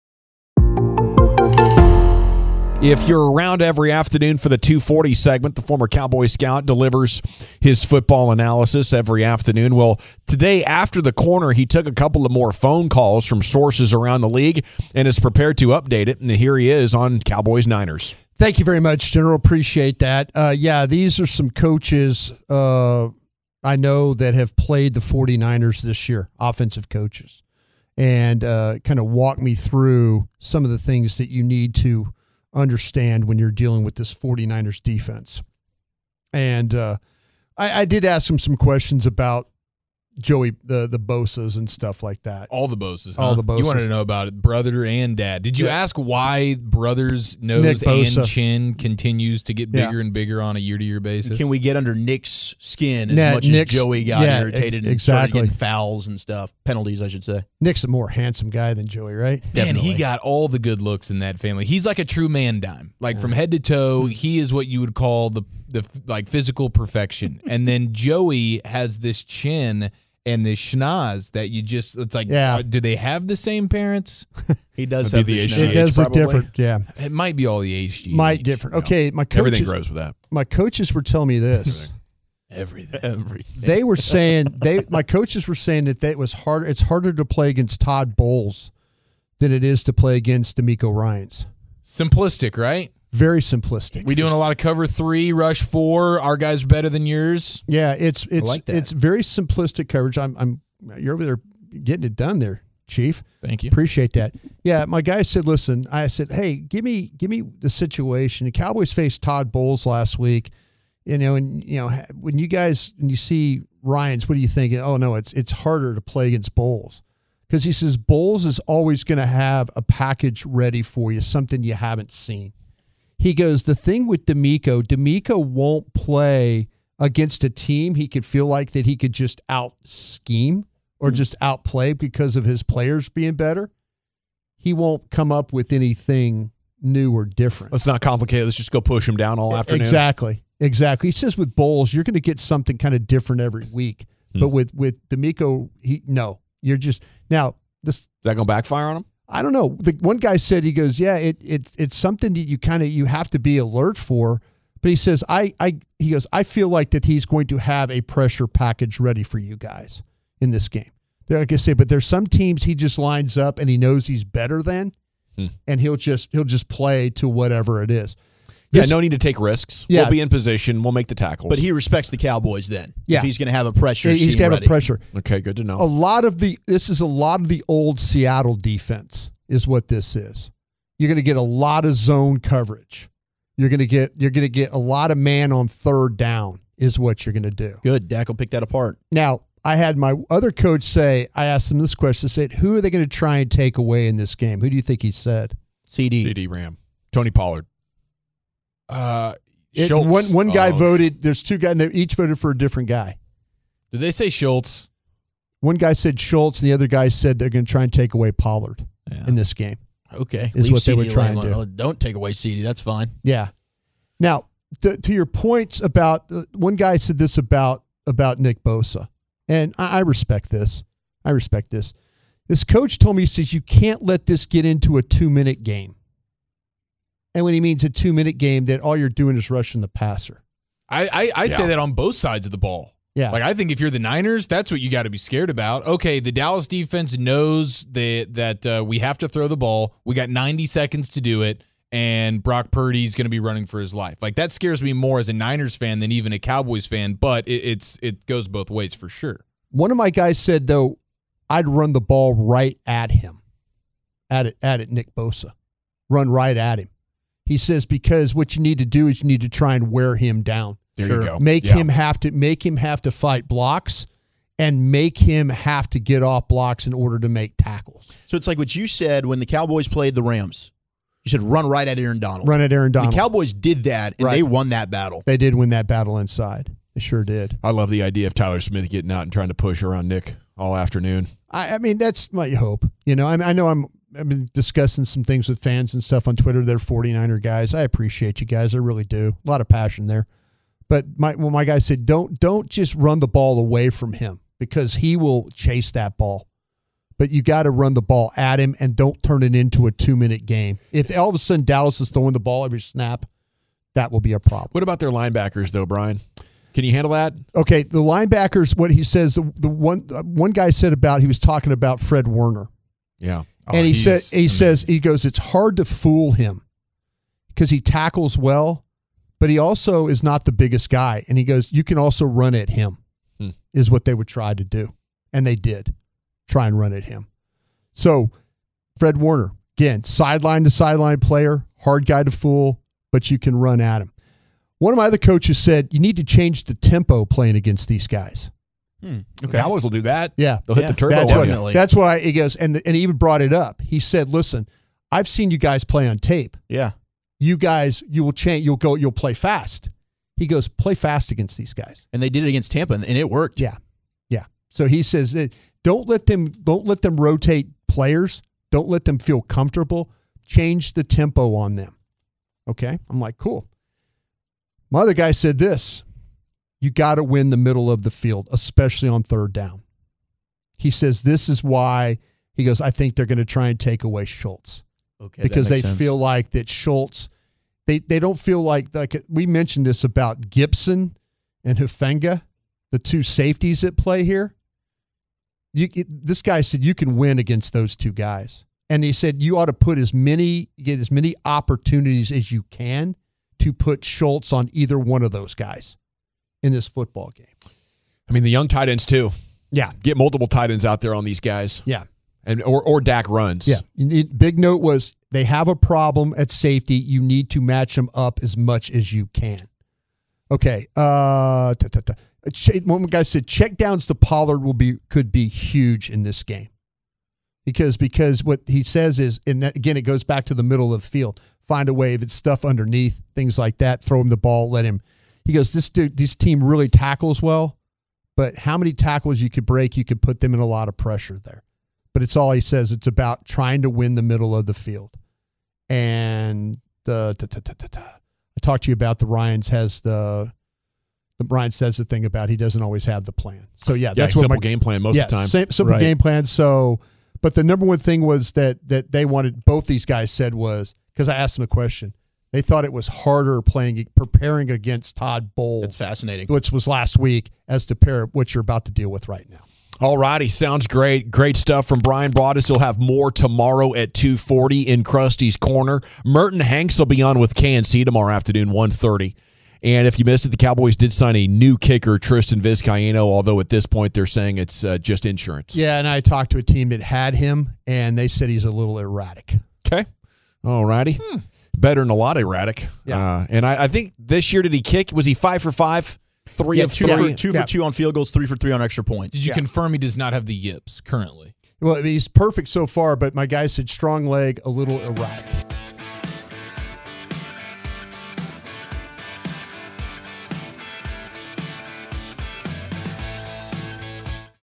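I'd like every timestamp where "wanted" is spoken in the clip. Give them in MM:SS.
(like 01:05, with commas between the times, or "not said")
00:43, 07:29.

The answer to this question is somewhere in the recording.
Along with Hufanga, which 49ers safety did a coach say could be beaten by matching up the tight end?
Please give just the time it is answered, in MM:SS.
06:20.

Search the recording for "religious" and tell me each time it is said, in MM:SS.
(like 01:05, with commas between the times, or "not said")
not said.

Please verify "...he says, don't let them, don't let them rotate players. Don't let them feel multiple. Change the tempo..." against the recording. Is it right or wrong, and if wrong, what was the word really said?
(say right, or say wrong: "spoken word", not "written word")
wrong: "comfortable", not "multiple".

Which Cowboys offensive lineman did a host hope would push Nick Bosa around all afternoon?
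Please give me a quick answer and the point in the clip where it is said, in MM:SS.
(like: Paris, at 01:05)
Tyler Smith, at 04:38.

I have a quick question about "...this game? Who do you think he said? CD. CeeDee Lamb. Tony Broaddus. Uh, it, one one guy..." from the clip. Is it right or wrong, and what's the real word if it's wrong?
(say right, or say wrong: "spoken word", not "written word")
wrong: "Pollard", not "Broaddus".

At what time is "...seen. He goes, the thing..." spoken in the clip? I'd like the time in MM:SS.
02:02.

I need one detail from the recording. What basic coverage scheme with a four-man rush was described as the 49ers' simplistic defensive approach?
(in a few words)
Cover three.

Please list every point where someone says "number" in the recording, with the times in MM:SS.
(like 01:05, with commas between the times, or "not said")
07:27.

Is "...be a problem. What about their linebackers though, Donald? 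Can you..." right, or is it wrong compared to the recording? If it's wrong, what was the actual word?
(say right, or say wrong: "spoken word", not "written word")
wrong: "Brian", not "Donald".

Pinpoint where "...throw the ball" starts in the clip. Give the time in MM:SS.
03:59.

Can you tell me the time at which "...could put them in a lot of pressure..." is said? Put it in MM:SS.
07:10.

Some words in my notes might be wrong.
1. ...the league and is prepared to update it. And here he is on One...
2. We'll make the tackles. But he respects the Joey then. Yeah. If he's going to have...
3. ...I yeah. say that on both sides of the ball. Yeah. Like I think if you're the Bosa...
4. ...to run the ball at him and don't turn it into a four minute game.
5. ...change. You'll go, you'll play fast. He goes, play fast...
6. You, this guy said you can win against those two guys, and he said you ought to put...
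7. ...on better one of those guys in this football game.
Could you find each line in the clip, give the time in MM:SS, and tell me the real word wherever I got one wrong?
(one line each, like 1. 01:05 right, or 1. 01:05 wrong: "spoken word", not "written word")
1. 00:14 wrong: "Cowboys", not "One"
2. 02:50 wrong: "Cowboys", not "Joey"
3. 03:51 wrong: "Niners", not "Bosa"
4. 04:57 wrong: "two", not "four"
5. 05:48 right
6. 06:25 right
7. 06:34 wrong: "either", not "better".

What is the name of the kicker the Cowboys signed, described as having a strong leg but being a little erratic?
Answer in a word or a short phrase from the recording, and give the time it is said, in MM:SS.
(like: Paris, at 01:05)
Tristan Vizcaino, at 07:52.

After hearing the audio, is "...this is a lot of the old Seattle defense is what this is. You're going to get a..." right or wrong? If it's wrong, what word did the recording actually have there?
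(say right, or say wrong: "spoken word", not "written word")
right.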